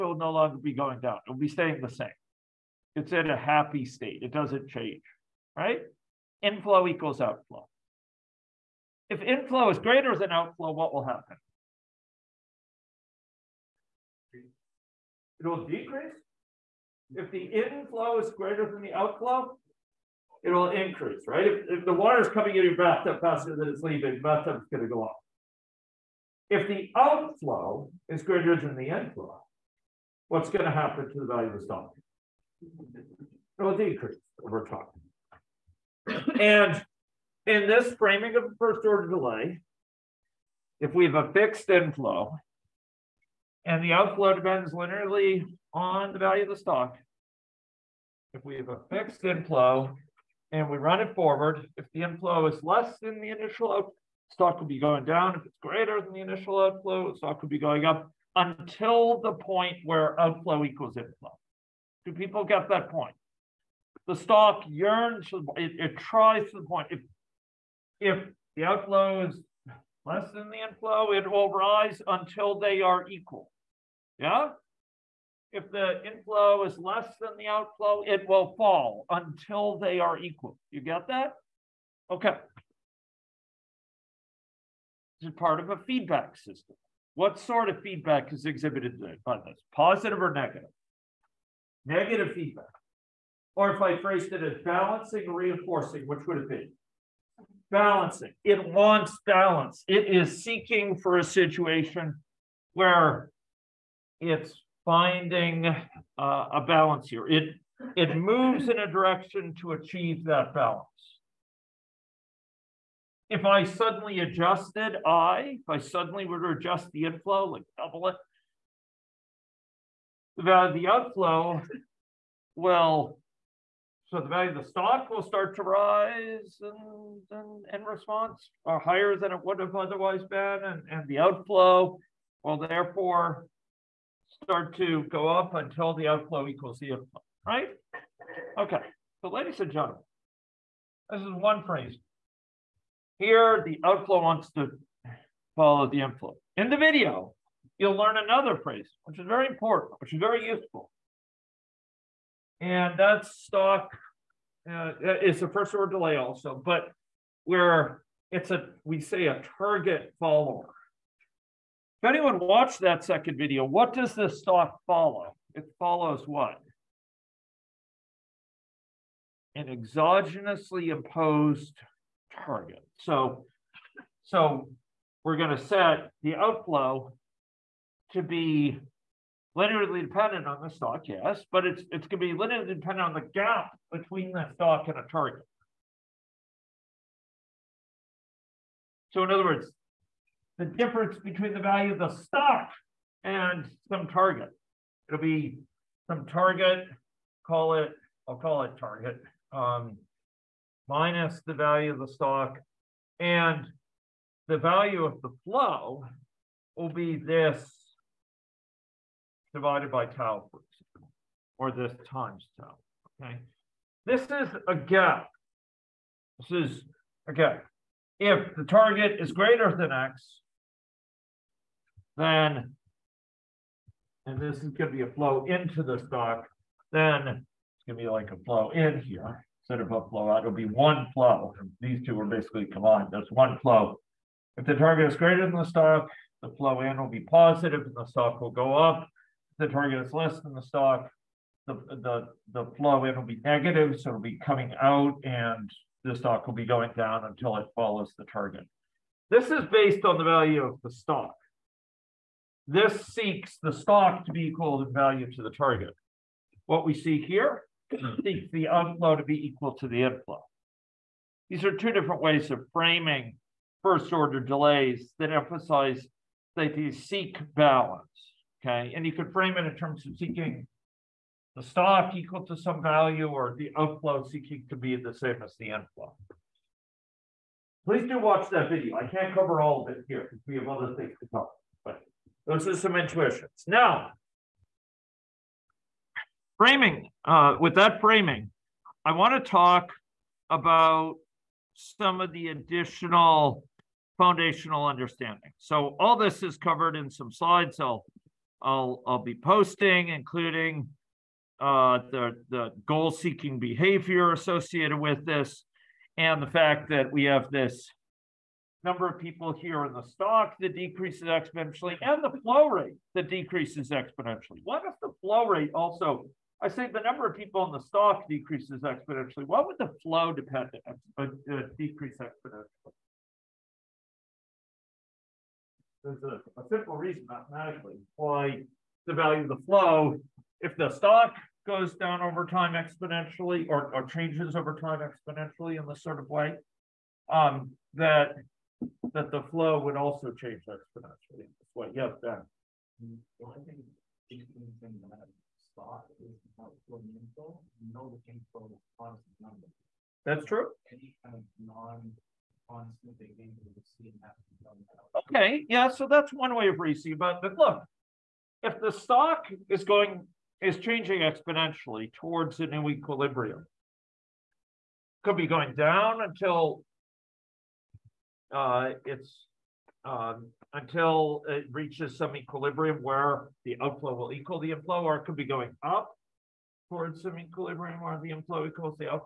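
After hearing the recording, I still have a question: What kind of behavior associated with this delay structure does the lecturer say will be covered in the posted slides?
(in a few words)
Goal-seeking behavior.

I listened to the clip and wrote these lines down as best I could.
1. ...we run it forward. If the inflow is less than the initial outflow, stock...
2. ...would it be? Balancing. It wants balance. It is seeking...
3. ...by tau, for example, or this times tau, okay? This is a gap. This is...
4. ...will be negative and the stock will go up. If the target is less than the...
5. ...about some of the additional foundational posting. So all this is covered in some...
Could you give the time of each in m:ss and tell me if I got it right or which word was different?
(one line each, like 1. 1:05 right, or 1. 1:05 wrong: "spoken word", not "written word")
1. 0:50 right
2. 1:36 right
3. 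3:29 right
4. 3:56 wrong: "positive", not "negative"
5. 4:50 wrong: "understanding", not "posting".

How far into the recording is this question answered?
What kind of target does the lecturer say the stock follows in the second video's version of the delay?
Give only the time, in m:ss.
2:49.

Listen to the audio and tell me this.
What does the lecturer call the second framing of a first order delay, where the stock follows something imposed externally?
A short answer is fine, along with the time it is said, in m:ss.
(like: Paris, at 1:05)
Target follower, at 2:39.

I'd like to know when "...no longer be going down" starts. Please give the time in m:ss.
0:00.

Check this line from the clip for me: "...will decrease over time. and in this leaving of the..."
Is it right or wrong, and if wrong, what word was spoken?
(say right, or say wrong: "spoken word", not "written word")
wrong: "framing", not "leaving".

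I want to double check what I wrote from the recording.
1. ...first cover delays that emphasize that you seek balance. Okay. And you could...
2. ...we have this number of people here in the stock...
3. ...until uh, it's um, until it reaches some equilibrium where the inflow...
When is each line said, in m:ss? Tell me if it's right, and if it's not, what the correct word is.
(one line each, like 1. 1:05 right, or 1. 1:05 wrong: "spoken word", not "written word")
1. 4:23 wrong: "order", not "cover"
2. 5:07 right
3. 6:06 wrong: "outflow", not "inflow".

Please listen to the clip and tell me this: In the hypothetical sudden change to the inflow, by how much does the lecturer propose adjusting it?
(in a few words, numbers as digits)
Double it.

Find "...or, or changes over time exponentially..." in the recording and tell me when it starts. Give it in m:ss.
5:33.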